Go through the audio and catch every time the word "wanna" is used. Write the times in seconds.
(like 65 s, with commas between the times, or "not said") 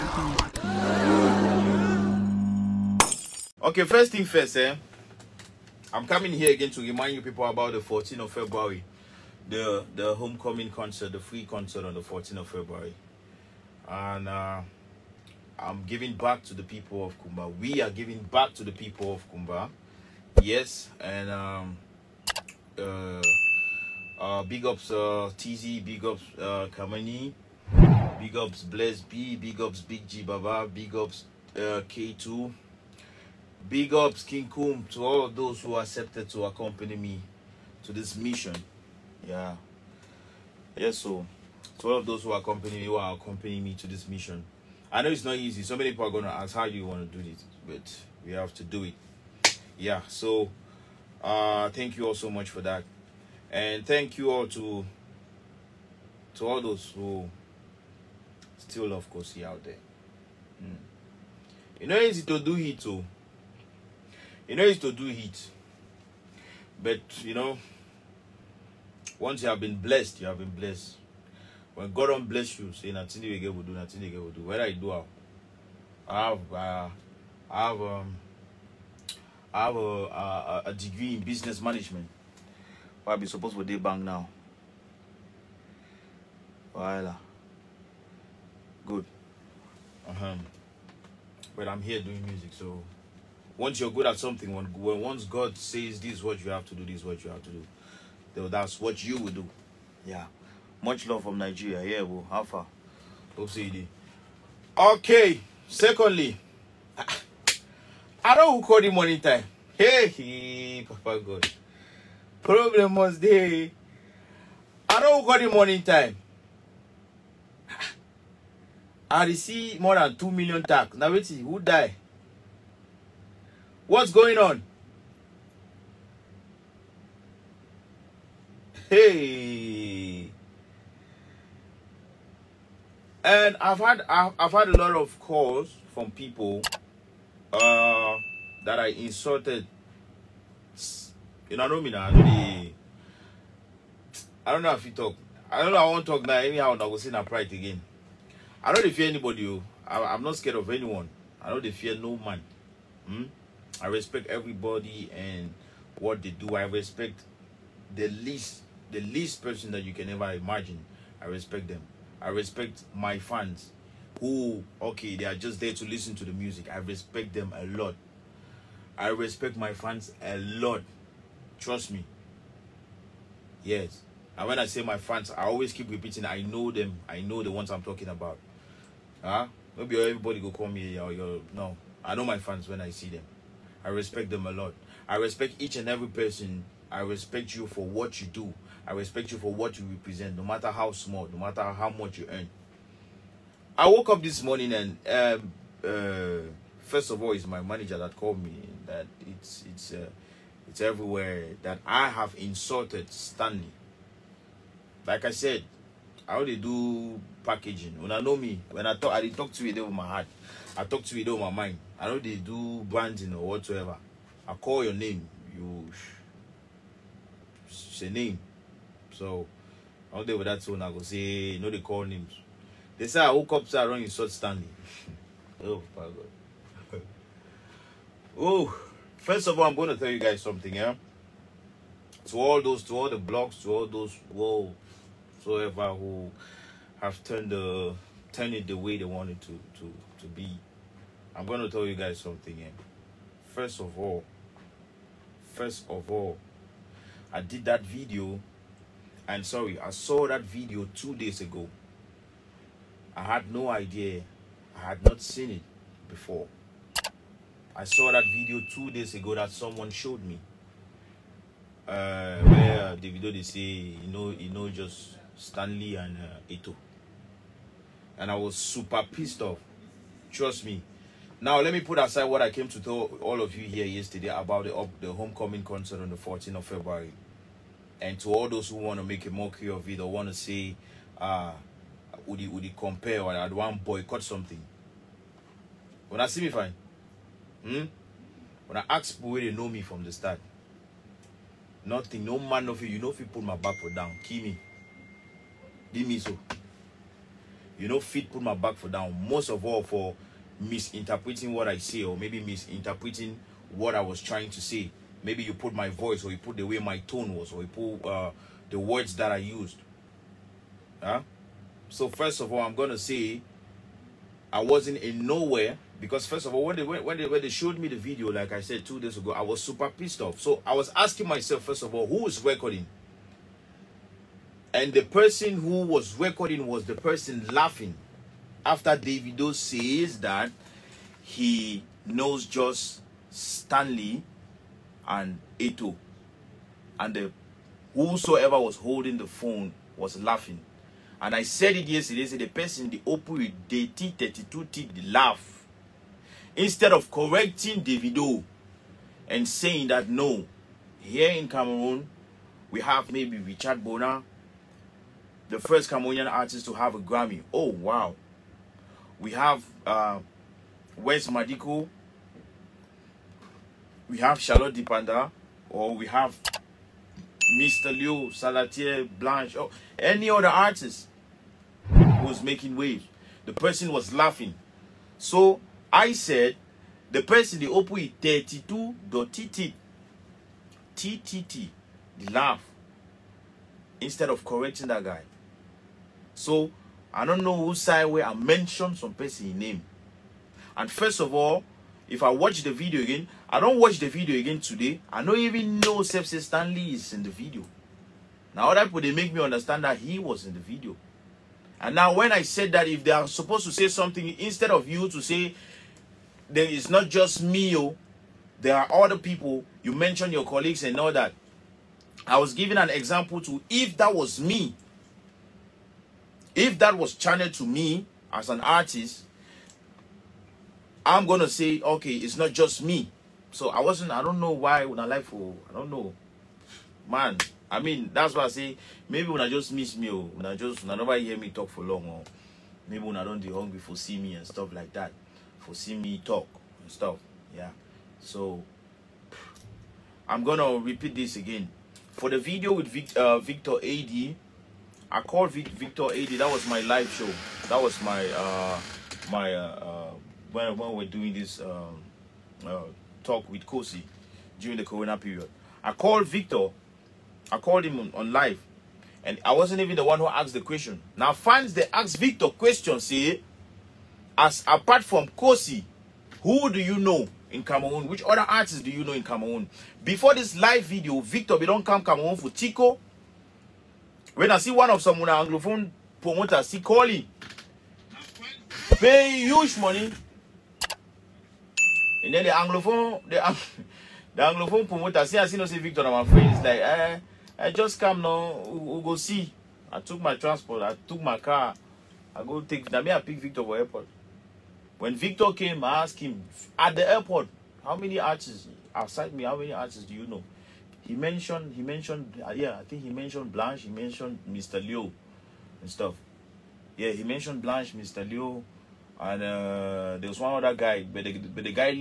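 46 s.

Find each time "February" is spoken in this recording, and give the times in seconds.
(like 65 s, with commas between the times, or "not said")
8 s, 12 s, 276 s.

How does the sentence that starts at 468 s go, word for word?
Which other artists do you know in Cameroon?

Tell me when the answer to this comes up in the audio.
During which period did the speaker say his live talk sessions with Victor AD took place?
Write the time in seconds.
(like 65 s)
454 s.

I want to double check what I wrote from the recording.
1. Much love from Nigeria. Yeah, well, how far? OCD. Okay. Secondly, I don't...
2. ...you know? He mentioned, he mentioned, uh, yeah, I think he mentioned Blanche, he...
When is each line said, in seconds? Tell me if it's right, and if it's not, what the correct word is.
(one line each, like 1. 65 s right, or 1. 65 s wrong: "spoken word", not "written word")
1. 100 s right
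2. 500 s right.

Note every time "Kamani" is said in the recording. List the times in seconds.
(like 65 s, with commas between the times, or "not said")
26 s.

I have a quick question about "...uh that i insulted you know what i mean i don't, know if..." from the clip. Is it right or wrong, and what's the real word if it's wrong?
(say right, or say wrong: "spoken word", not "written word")
right.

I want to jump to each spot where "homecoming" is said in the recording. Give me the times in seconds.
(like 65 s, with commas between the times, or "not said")
10 s, 275 s.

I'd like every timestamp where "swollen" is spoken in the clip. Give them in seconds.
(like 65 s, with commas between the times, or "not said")
not said.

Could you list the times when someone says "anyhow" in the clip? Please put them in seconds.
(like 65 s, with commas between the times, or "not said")
146 s.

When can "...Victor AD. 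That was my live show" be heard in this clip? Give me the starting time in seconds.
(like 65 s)
445 s.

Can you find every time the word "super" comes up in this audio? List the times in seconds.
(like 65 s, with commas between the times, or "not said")
268 s, 319 s.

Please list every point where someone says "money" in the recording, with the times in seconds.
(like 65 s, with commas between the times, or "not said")
108 s, 479 s.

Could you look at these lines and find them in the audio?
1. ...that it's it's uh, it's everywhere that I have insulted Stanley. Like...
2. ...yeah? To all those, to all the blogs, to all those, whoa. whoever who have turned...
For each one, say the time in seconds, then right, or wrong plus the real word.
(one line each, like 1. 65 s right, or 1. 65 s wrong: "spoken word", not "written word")
1. 198 s right
2. 230 s right.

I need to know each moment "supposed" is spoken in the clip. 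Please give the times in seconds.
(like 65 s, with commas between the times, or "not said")
83 s, 403 s.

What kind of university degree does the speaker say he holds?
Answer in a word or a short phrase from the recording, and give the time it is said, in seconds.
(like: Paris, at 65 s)
Business management, at 81 s.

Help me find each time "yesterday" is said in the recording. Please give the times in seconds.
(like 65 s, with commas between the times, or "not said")
273 s, 341 s.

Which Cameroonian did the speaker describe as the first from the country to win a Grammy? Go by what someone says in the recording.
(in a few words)
Richard Bona.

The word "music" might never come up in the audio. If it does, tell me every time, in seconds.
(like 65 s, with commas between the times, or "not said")
92 s, 166 s.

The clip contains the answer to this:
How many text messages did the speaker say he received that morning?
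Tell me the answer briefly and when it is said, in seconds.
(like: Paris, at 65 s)
More than 2 million, at 119 s.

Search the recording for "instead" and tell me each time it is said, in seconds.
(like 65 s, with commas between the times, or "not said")
346 s, 383 s, 404 s.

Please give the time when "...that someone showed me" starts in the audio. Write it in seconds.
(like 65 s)
259 s.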